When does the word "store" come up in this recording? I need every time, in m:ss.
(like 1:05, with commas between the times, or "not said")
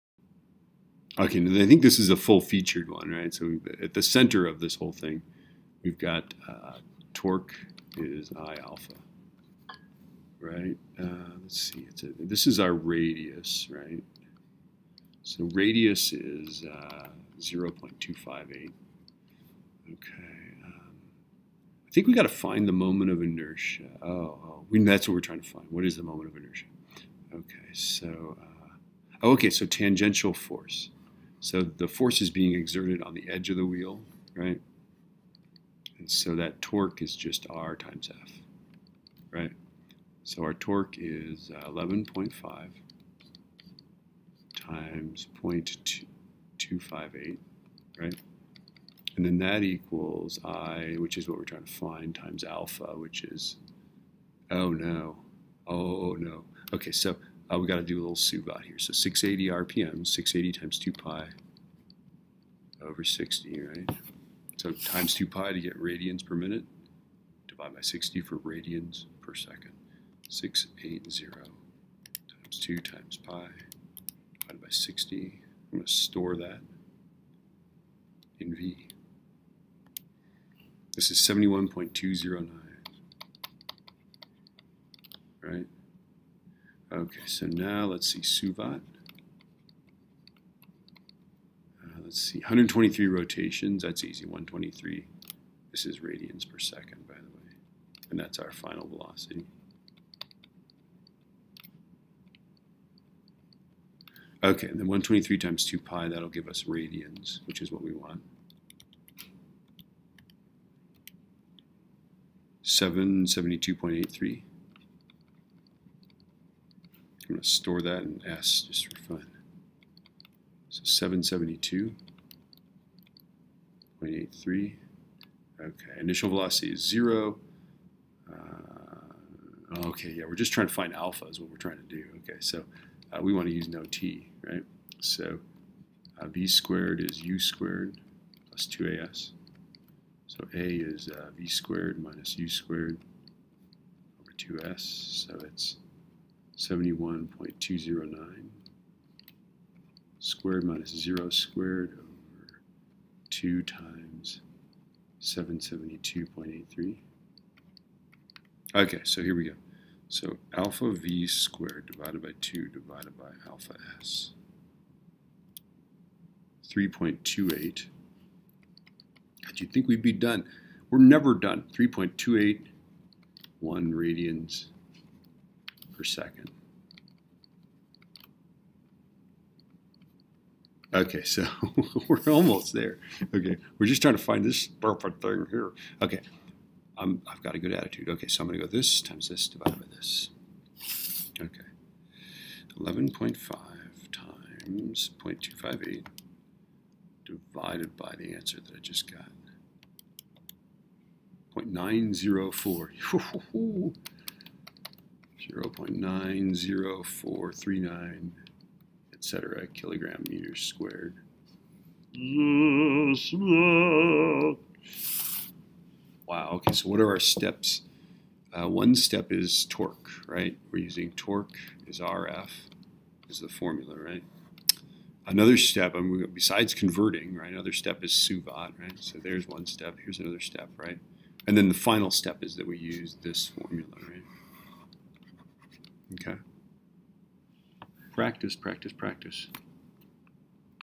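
1:15, 1:57.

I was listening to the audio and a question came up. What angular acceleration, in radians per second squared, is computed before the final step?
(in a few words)
3.281.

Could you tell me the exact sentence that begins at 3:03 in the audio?
Okay, we're just trying to find this perfect thing here.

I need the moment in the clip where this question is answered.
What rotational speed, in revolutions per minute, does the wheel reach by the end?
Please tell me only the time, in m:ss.
0:58.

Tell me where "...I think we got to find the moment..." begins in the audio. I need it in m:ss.
0:21.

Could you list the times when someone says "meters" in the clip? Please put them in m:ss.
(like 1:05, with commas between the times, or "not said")
3:30.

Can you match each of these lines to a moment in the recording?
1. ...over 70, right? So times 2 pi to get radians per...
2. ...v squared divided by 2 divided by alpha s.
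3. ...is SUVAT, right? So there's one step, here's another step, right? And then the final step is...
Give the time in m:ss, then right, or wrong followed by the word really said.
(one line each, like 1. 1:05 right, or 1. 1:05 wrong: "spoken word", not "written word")
1. 1:02 wrong: "60", not "70"
2. 2:40 right
3. 3:48 right.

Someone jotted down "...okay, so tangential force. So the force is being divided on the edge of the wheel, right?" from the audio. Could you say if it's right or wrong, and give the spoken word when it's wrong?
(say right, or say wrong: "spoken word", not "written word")
wrong: "exerted", not "divided".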